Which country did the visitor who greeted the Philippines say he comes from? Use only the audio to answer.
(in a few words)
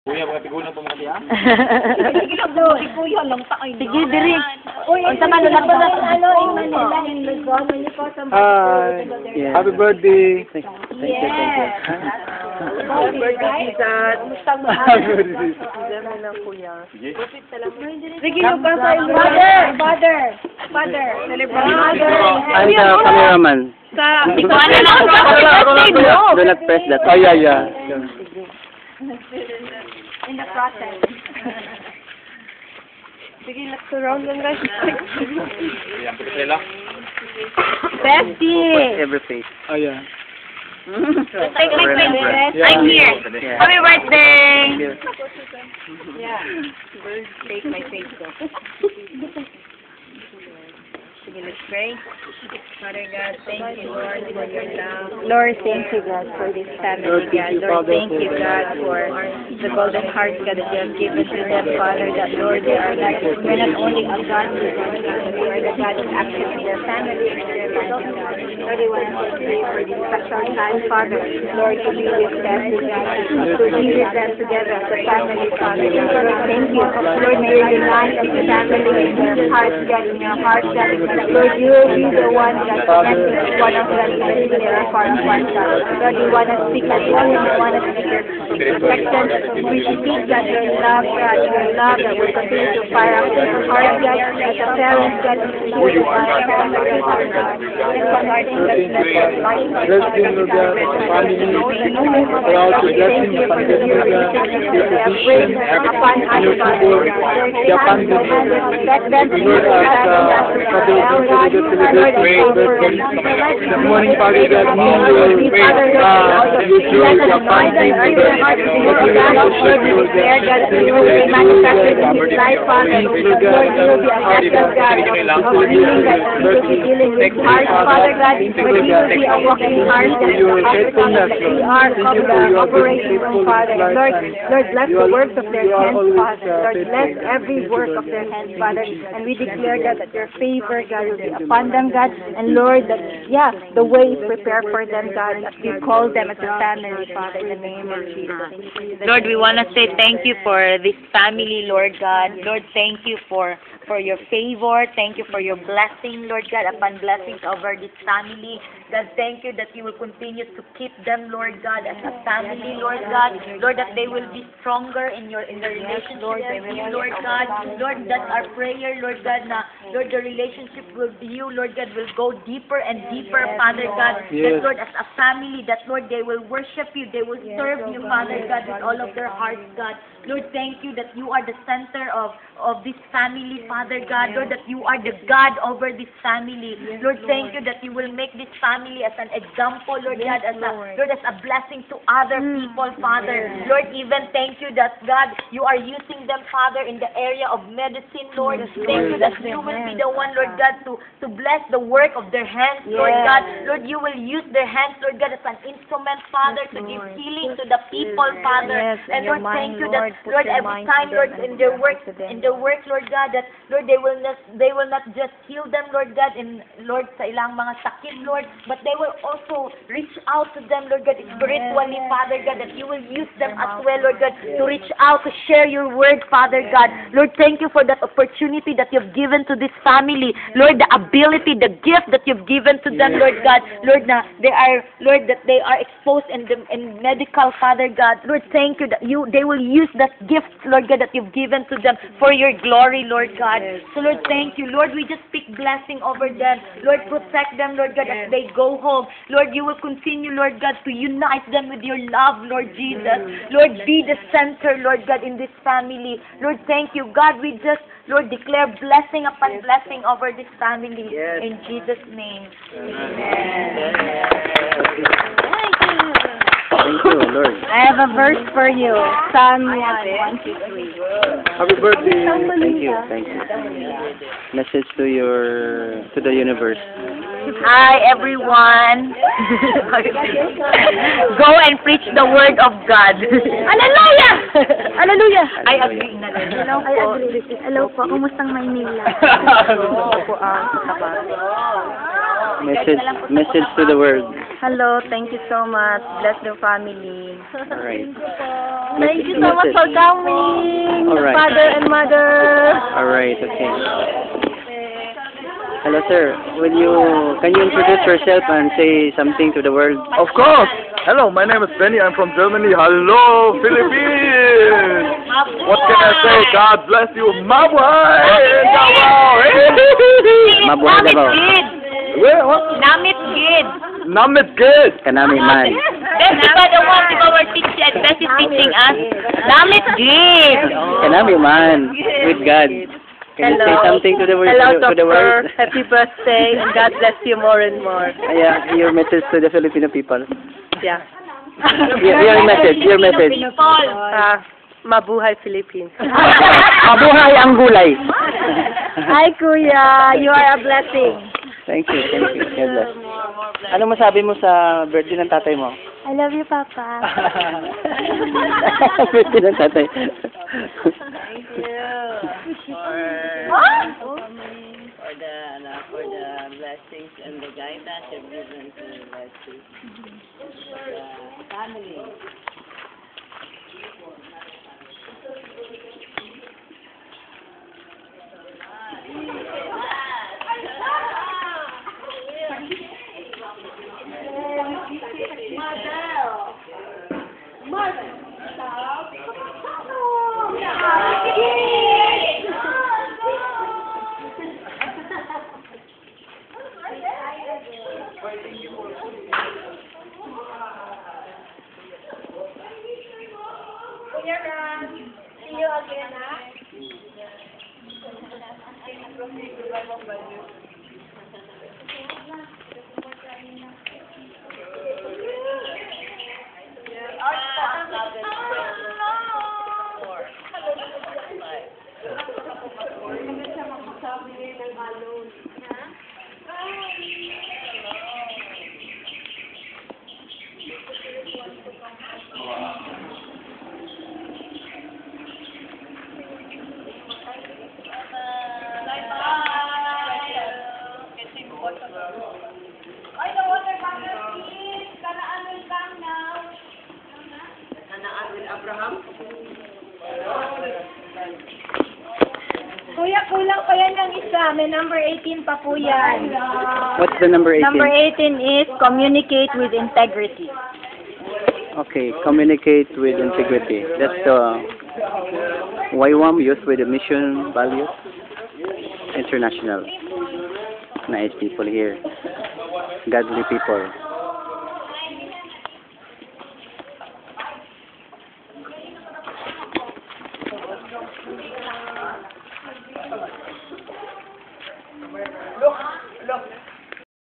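Germany.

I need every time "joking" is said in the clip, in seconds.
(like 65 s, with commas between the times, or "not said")
not said.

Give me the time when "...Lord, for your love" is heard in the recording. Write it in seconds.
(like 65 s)
53 s.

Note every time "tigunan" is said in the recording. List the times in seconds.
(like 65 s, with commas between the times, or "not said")
0 s.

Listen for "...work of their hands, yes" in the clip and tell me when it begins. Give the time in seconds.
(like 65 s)
201 s.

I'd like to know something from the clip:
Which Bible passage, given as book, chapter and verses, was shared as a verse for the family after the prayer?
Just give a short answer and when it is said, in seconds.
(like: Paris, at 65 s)
Psalm 1:1-3, at 269 s.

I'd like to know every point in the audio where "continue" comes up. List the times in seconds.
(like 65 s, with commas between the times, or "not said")
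92 s, 159 s, 249 s.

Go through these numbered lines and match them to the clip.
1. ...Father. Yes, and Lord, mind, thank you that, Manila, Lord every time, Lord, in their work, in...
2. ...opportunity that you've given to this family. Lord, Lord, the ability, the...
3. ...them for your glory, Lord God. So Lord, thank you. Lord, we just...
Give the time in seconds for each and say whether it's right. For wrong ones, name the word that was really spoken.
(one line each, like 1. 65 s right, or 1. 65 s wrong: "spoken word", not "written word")
1. 208 s wrong: "Lord", not "Manila"
2. 228 s right
3. 241 s right.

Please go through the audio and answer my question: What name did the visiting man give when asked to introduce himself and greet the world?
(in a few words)
Benny.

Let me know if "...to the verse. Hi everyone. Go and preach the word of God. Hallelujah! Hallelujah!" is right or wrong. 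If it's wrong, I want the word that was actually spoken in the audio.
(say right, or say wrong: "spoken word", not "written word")
wrong: "universe", not "verse".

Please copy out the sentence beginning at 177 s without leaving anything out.
They will yes, serve you, Father God, with all of their hearts, God.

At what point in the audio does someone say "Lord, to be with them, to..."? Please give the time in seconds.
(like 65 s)
71 s.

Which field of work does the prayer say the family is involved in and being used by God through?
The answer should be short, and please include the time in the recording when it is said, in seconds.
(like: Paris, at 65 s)
medicine, at 197 s.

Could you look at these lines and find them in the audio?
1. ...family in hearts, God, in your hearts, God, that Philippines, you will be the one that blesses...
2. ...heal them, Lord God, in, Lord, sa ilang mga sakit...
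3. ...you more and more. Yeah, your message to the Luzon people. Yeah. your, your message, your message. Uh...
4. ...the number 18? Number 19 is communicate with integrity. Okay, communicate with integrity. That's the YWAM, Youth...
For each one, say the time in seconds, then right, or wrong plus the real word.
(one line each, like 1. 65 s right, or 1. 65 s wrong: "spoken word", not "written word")
1. 78 s wrong: "Lord", not "Philippines"
2. 215 s right
3. 337 s wrong: "Filipino", not "Luzon"
4. 457 s wrong: "18", not "19".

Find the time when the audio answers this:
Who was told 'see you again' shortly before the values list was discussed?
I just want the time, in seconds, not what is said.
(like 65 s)
398 s.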